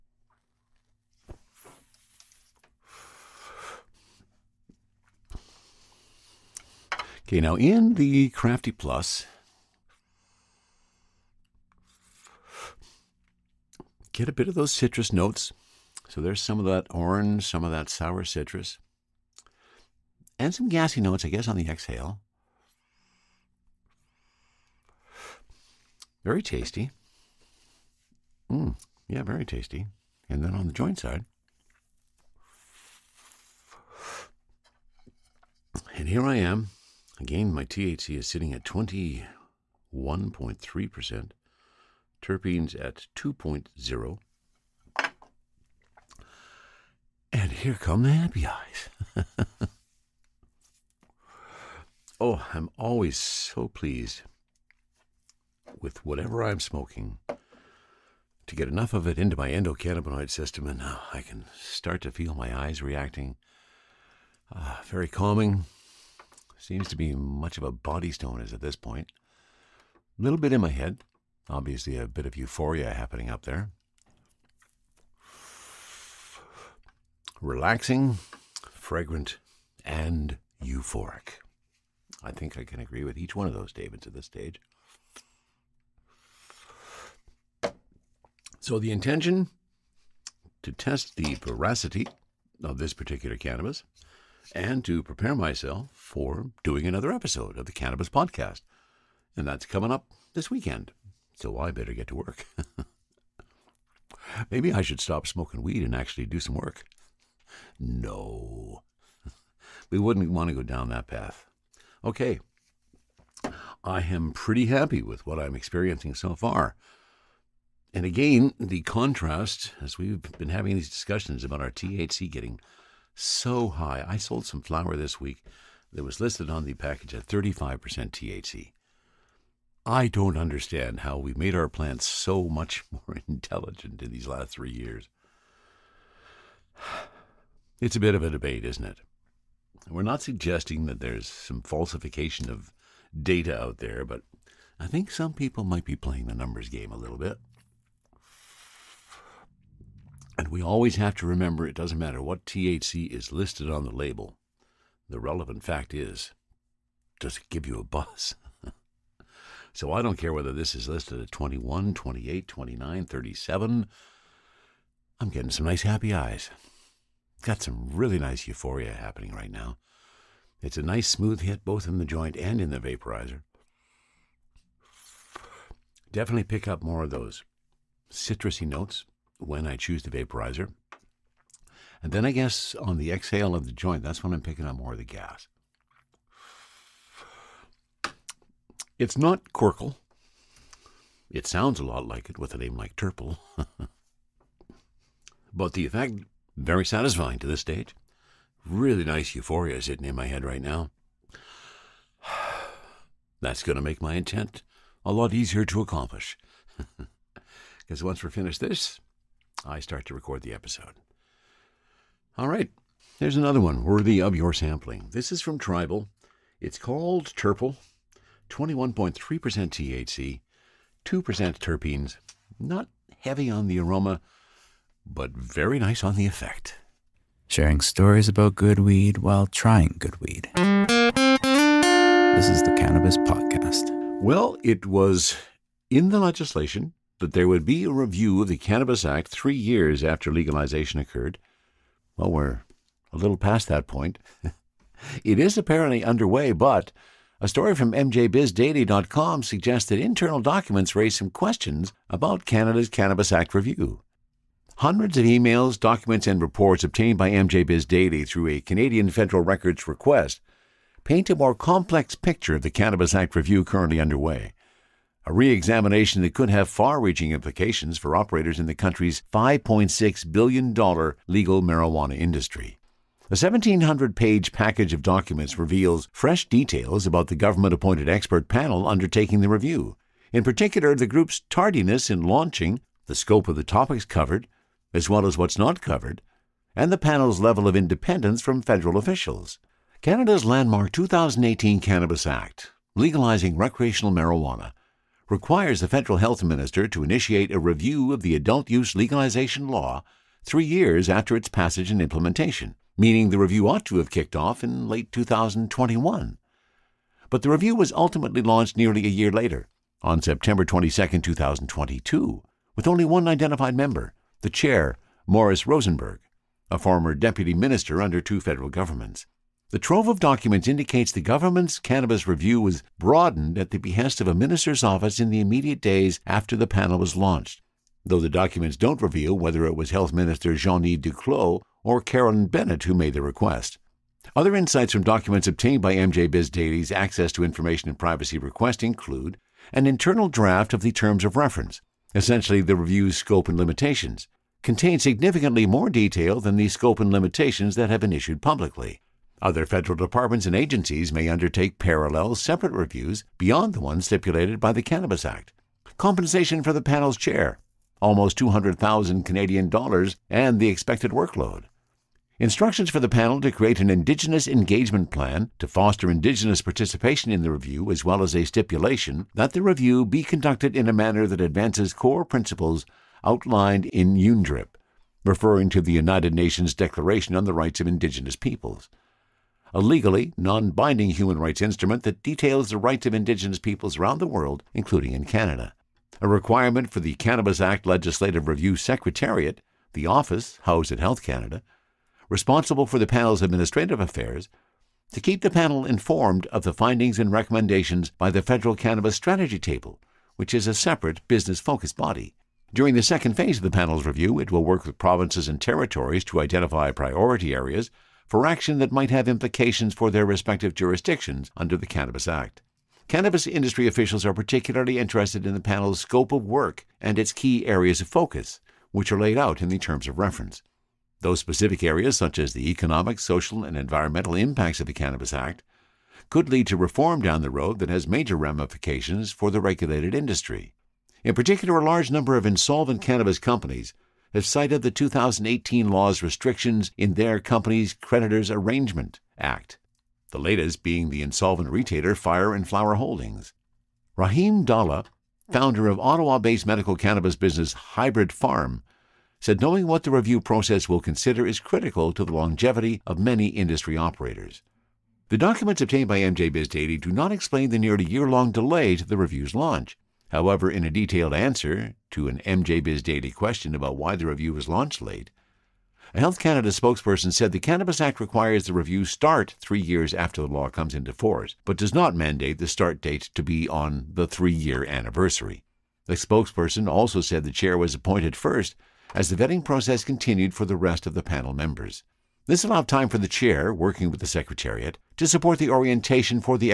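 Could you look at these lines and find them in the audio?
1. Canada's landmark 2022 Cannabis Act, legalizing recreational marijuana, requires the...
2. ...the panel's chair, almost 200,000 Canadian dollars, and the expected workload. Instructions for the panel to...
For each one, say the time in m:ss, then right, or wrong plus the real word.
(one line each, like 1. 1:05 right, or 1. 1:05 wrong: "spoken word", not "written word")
1. 4:50 wrong: "2018", not "2022"
2. 5:56 right.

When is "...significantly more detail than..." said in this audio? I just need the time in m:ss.
5:45.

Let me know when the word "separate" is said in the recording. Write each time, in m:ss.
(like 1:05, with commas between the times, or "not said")
5:52, 6:40.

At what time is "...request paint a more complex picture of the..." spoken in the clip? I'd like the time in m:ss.
4:19.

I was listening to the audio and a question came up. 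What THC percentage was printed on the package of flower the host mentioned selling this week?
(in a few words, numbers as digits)
35%.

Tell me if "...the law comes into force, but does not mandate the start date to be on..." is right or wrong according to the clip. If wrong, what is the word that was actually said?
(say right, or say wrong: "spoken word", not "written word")
right.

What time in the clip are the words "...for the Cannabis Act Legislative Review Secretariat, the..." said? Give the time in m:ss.
6:26.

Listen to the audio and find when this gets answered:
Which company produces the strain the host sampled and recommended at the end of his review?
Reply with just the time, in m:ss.
3:35.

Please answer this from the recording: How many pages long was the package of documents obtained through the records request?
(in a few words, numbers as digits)
1,700.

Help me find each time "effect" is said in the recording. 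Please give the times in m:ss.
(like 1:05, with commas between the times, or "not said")
3:15, 3:46.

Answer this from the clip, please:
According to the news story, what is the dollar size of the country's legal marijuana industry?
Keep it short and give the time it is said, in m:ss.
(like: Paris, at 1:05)
$5.6 billion, at 4:29.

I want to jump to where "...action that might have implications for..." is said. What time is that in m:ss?
6:48.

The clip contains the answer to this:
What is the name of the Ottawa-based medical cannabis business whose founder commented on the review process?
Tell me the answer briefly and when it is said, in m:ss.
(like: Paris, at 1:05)
Hybrid Pharm, at 7:27.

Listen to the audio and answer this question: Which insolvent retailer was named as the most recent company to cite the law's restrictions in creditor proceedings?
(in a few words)
Fire and Flower Holdings.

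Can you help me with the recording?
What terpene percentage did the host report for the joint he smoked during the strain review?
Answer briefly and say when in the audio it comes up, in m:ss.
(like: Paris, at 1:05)
2.0, at 0:42.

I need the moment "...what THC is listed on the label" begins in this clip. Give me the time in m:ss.
2:32.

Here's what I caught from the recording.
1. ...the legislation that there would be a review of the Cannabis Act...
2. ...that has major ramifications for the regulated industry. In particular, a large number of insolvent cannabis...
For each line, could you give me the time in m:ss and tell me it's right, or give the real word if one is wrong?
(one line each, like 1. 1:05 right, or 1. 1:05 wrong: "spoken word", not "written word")
1. 3:56 right
2. 7:07 right.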